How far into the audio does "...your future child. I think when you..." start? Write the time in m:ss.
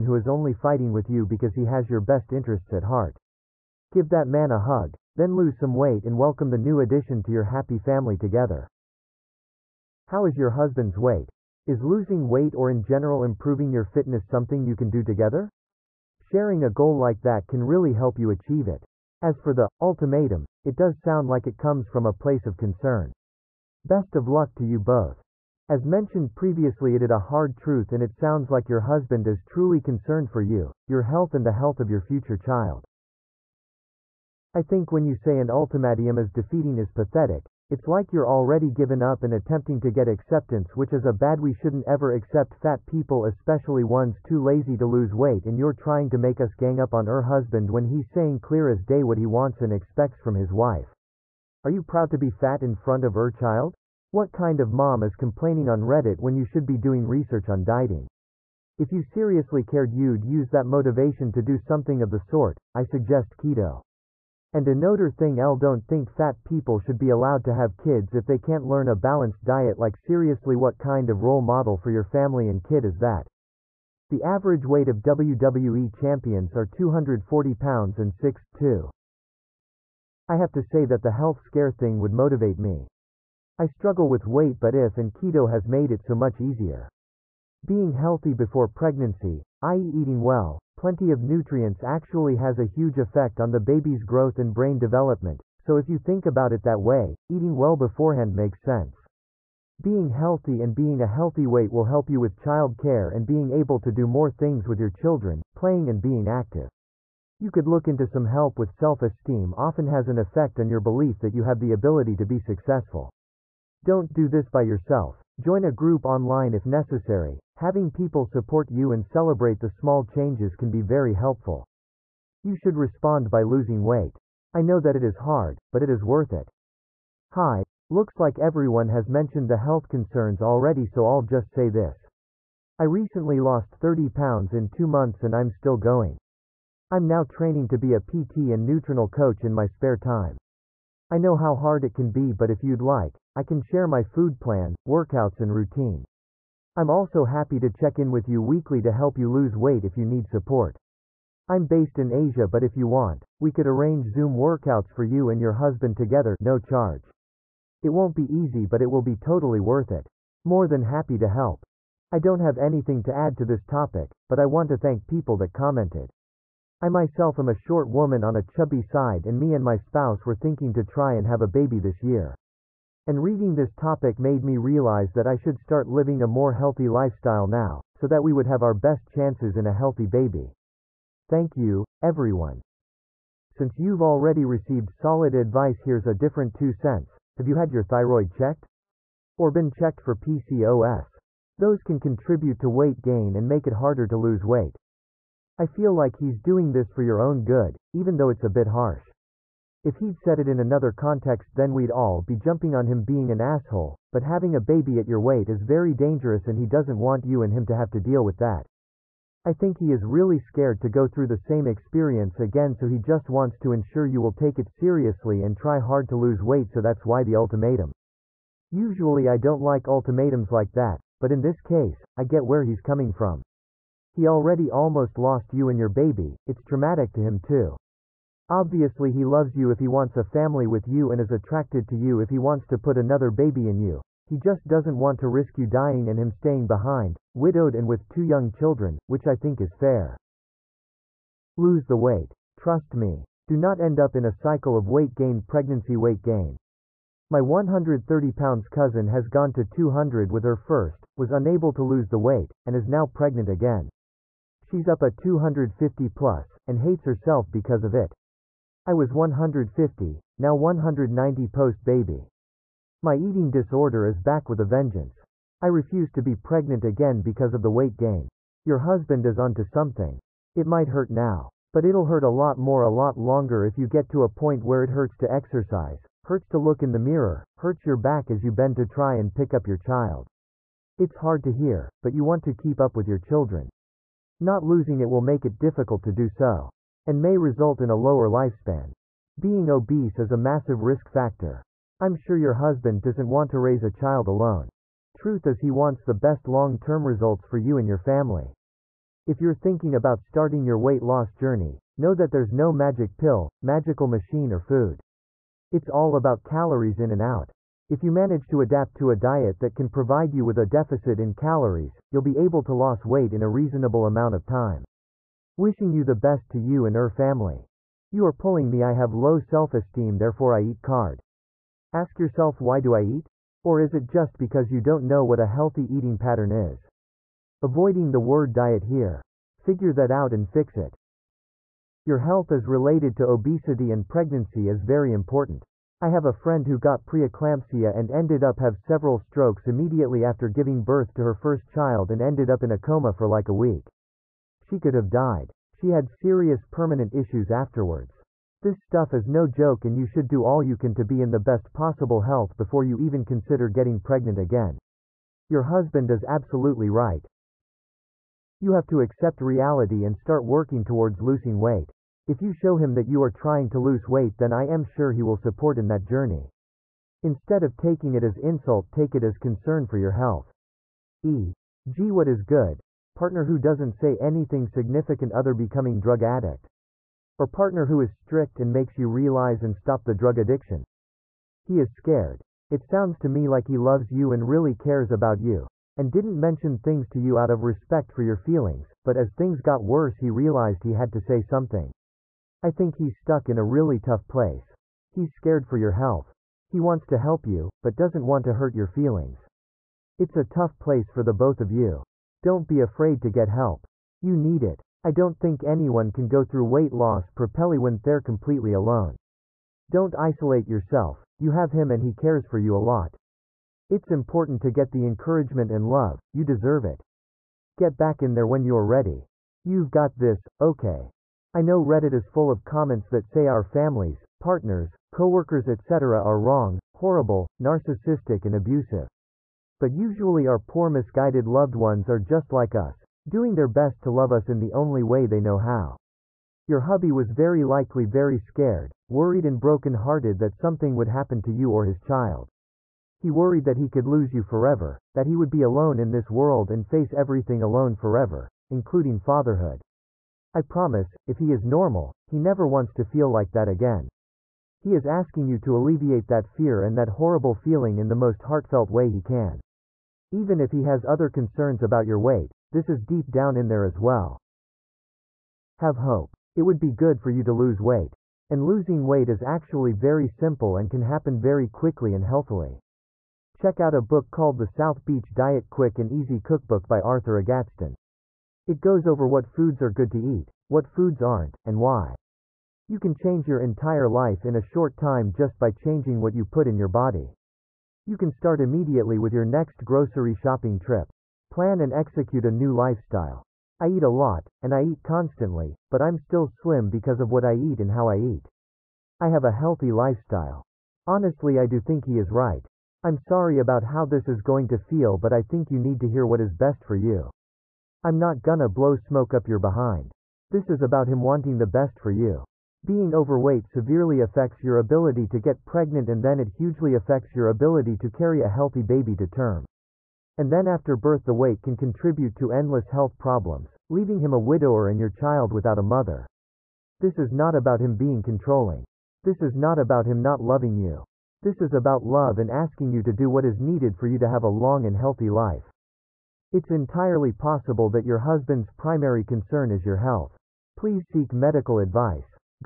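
0:31.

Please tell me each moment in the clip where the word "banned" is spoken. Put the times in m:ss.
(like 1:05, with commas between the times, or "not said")
not said.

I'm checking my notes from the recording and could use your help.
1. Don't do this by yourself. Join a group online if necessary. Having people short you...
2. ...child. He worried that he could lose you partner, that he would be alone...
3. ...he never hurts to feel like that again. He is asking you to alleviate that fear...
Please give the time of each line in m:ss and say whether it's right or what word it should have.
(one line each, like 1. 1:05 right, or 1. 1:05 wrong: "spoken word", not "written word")
1. 1:53 wrong: "support", not "short"
2. 7:21 wrong: "forever", not "partner"
3. 7:32 wrong: "wants", not "hurts".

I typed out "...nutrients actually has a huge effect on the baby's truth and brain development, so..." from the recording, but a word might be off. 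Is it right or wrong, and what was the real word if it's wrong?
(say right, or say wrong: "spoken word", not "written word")
wrong: "growth", not "truth".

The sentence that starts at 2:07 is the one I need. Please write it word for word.
Hi, looks like everyone has mentioned the health concerns already, so I'll just say this.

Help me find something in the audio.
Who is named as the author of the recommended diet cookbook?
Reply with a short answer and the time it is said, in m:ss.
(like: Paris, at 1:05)
Arthur Agatston, at 7:56.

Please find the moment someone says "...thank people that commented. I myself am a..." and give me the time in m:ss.
2:44.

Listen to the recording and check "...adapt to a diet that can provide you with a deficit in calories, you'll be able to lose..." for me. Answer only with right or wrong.
right.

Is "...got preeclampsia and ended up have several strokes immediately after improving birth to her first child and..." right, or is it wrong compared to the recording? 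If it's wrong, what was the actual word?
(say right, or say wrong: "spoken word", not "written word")
wrong: "giving", not "improving".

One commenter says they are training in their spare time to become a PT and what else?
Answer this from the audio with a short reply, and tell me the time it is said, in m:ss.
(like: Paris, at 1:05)
nutritional coach, at 2:18.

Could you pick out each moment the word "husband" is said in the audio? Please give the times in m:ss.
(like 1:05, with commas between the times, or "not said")
0:10, 0:28, 0:47, 2:35, 4:28, 4:52, 5:55, 8:58.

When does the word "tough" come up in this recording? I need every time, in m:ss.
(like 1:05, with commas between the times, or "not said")
6:33, 6:40.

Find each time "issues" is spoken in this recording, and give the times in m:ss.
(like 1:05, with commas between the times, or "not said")
5:47.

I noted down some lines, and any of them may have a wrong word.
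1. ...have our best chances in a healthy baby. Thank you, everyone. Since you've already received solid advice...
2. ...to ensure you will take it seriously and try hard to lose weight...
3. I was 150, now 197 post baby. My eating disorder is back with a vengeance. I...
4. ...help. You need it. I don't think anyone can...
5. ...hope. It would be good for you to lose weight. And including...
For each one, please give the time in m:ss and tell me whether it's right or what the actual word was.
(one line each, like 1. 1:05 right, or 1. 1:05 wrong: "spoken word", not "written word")
1. 2:58 right
2. 3:33 right
3. 4:18 wrong: "190", not "197"
4. 6:43 right
5. 7:45 wrong: "losing", not "including".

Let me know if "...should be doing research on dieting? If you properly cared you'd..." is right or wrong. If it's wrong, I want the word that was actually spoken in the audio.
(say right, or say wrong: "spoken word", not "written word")
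wrong: "seriously", not "properly".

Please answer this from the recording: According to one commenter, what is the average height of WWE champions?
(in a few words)
6'2".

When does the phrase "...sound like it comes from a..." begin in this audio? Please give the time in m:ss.
0:21.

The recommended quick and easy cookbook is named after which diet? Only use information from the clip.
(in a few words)
South Beach Diet.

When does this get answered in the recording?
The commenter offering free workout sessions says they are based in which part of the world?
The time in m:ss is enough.
2:32.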